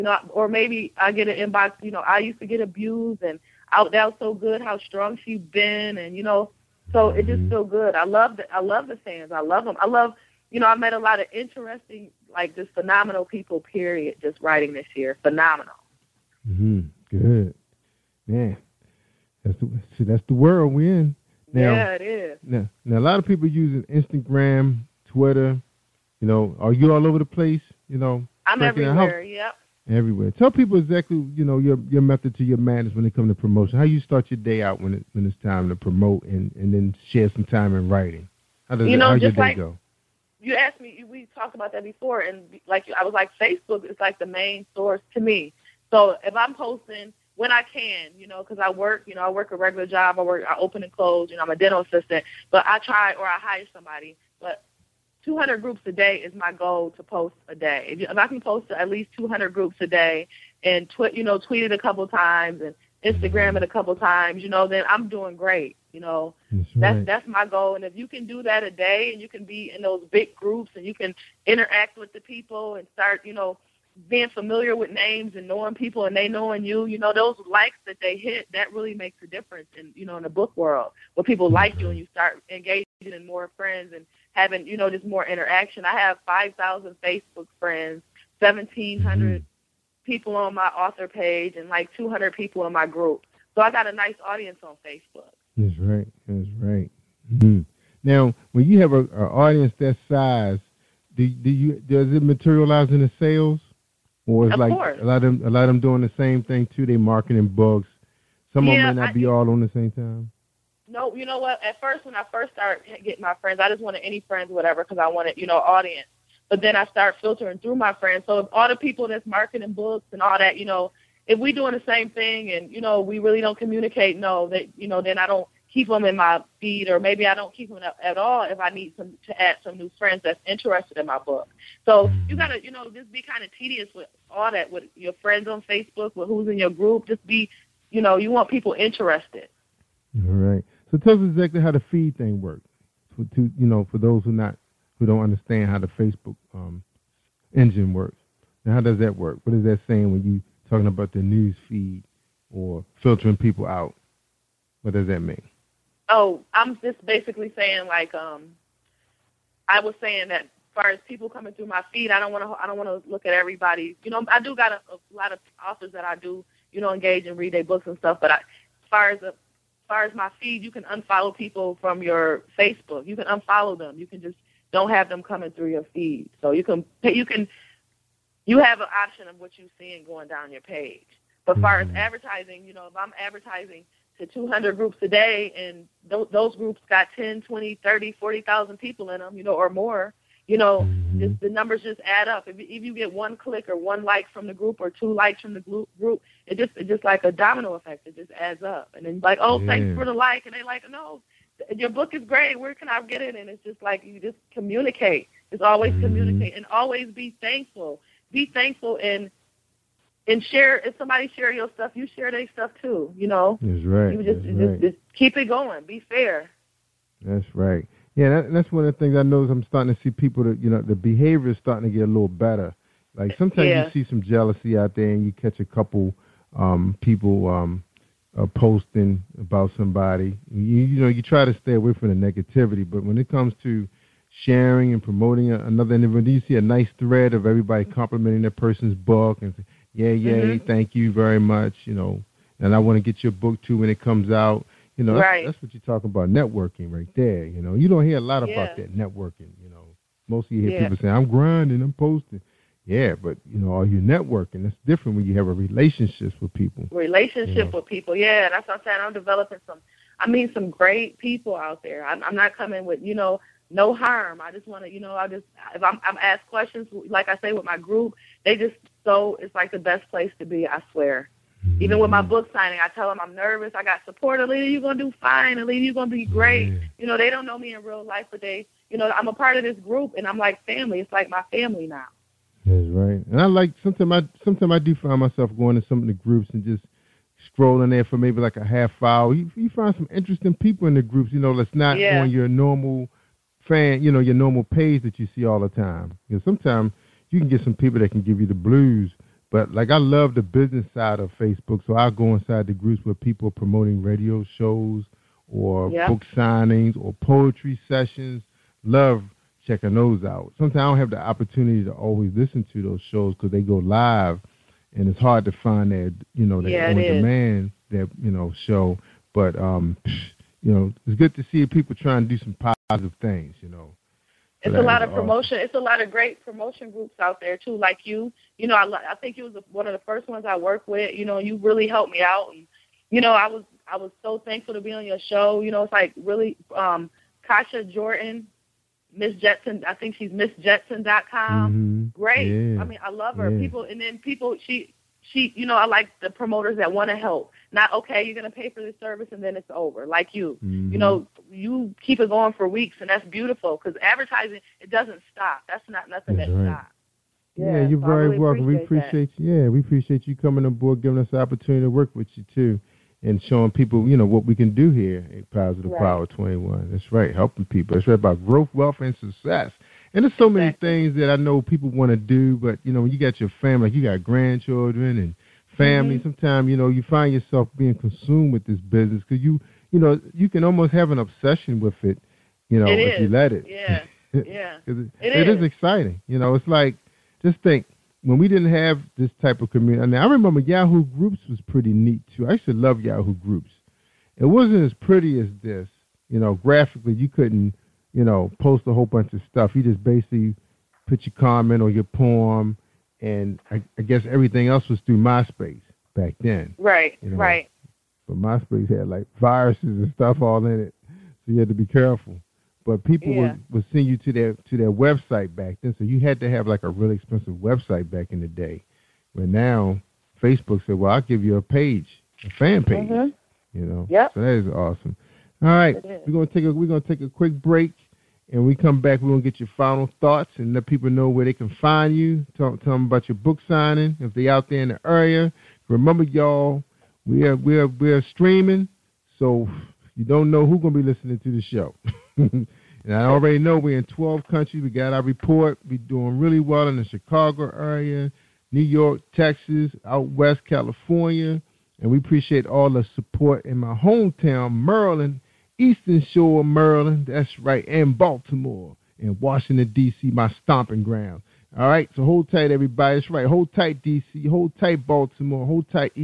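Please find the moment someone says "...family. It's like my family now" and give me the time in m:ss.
4:40.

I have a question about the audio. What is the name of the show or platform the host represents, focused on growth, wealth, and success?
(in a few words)
Positive Power 21.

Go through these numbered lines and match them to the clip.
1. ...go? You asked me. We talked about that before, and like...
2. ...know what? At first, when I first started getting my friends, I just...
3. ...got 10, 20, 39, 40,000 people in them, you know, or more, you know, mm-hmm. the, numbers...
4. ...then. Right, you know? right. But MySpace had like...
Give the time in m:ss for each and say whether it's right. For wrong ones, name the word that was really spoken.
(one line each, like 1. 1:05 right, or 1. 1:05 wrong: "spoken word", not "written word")
1. 0:39 right
2. 1:51 right
3. 3:06 wrong: "30", not "39"
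4. 6:46 right.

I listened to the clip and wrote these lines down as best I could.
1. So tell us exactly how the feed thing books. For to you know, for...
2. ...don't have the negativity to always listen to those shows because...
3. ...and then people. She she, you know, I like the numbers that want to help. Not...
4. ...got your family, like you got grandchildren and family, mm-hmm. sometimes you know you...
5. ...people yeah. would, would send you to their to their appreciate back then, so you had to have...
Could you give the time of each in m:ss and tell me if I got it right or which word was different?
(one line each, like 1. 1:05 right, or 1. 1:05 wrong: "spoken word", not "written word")
1. 2:20 wrong: "works", not "books"
2. 5:10 wrong: "opportunity", not "negativity"
3. 5:43 wrong: "promoters", not "numbers"
4. 6:13 right
5. 6:53 wrong: "website", not "appreciate".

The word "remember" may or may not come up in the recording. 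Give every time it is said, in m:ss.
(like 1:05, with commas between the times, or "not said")
6:30, 7:15.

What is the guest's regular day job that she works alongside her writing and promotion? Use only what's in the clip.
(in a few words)
Dental assistant.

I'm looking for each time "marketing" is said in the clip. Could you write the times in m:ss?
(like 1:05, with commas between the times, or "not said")
1:46, 1:59.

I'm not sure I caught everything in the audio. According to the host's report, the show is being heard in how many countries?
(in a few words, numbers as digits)
12.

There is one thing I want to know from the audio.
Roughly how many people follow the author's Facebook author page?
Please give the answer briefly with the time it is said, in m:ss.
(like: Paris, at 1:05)
1700, at 1:28.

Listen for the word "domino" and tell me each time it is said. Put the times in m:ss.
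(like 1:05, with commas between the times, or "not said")
3:17.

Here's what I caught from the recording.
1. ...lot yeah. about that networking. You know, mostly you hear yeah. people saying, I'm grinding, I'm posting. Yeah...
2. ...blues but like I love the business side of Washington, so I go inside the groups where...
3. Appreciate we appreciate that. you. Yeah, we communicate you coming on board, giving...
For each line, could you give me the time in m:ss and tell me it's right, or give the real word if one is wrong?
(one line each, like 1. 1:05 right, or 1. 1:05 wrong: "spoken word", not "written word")
1. 4:08 right
2. 4:58 wrong: "Facebook", not "Washington"
3. 5:58 wrong: "appreciate", not "communicate".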